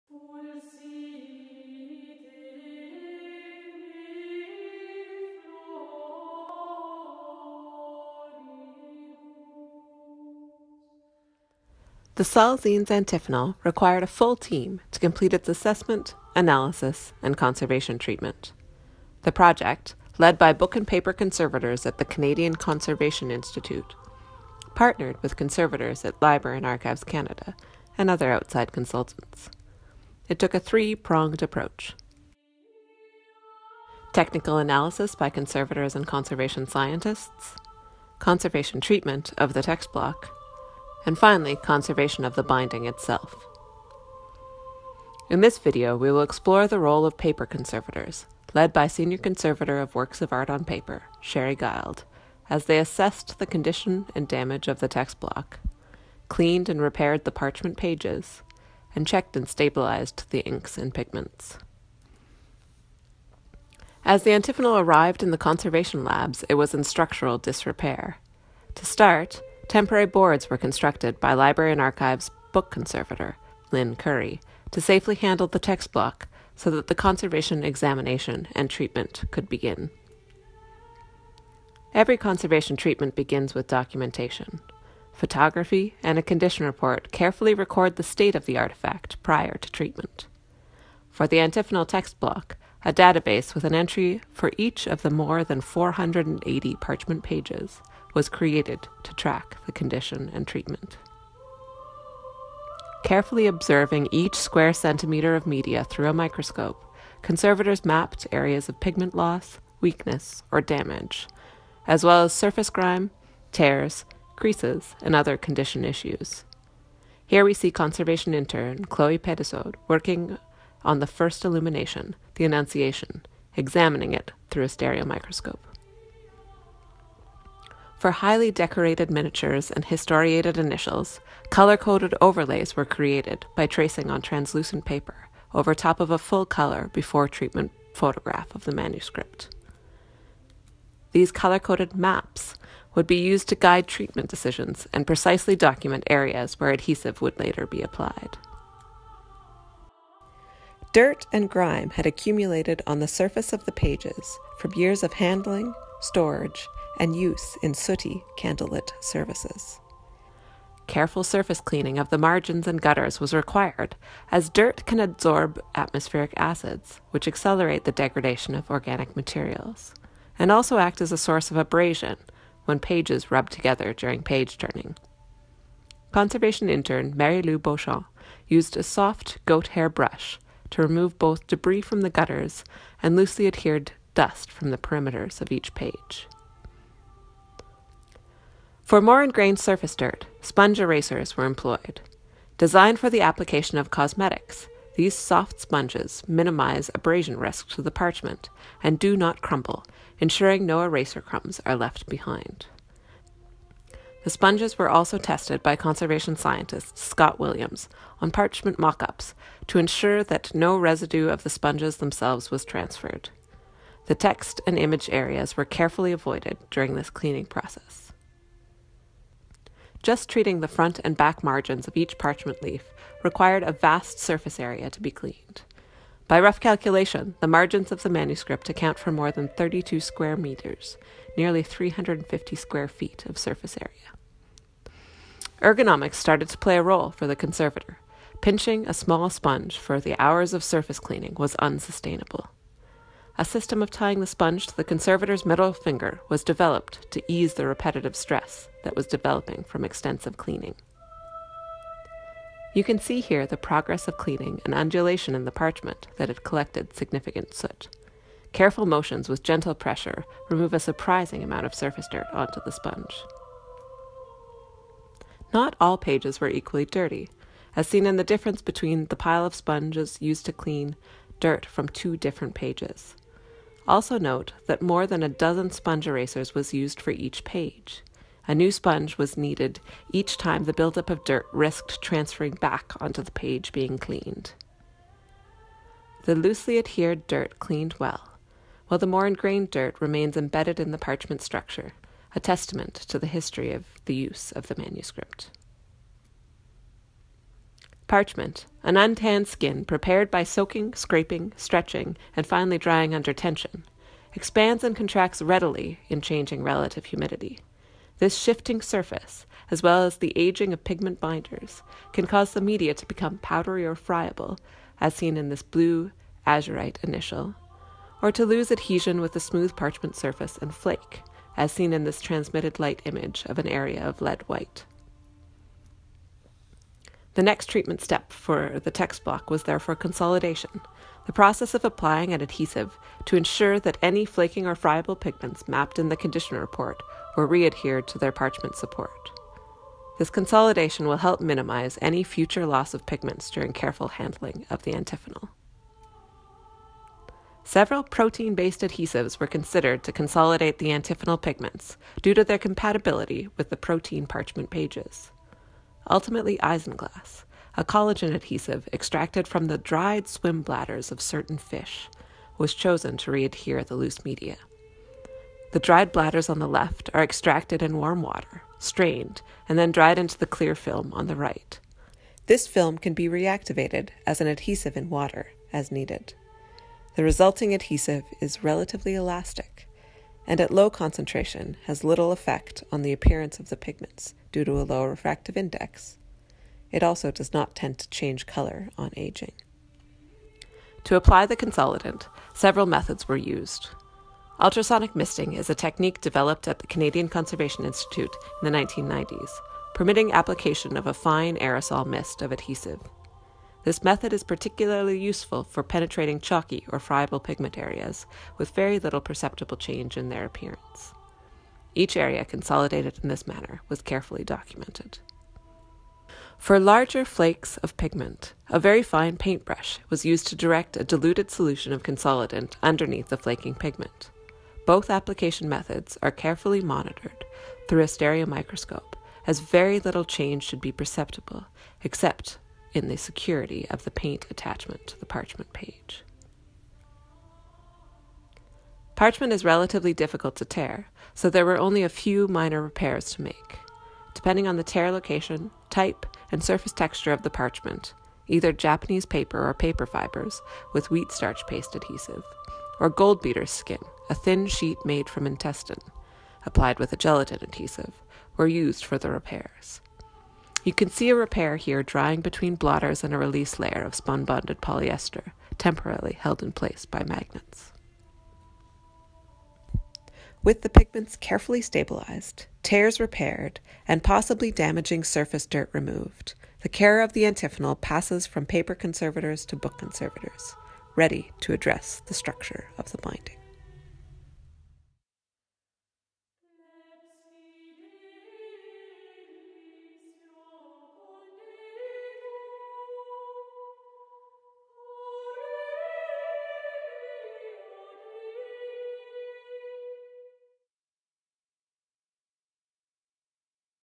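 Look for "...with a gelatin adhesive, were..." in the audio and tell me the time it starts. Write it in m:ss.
7:36.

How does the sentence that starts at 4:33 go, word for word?
Also note that more than a dozen sponge erasers was used for each page.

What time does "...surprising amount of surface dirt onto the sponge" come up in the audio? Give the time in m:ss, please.
4:20.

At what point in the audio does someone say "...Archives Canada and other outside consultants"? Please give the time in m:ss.
0:26.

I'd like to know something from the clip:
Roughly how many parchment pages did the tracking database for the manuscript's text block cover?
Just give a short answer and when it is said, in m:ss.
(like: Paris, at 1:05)
more than 480, at 1:35.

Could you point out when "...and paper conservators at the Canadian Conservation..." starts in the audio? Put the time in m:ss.
0:20.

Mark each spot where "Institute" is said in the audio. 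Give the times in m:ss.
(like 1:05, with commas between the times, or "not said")
0:23, 6:37.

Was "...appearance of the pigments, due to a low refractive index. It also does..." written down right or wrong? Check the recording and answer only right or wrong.
right.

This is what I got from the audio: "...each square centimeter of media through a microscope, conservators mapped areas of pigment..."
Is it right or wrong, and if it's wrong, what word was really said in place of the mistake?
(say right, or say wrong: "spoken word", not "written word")
right.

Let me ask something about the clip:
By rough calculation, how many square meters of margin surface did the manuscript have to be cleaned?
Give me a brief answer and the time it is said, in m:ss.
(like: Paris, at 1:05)
more than 32, at 3:49.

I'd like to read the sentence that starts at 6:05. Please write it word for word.
The dried bladders on the left are extracted in warm water, strained, and then dried into the clear film on the right.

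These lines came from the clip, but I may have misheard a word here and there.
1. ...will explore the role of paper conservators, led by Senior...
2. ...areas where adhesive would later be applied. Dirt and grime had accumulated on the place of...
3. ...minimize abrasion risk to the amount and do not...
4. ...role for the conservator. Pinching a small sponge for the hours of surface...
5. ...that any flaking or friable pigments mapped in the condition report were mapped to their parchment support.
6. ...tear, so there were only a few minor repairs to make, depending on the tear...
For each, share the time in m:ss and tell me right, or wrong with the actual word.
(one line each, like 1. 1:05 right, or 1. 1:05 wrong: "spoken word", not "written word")
1. 0:46 right
2. 2:26 wrong: "surface", not "place"
3. 3:16 wrong: "parchment", not "amount"
4. 3:56 right
5. 5:33 wrong: "readhered", not "mapped"
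6. 7:20 right.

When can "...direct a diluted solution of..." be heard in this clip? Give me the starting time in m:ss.
7:00.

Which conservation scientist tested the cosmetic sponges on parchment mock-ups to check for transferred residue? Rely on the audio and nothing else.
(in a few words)
Scott Williams.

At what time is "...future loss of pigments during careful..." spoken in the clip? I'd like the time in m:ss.
5:42.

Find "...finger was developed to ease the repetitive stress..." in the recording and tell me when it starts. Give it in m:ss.
4:05.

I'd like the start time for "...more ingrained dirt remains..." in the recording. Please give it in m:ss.
4:49.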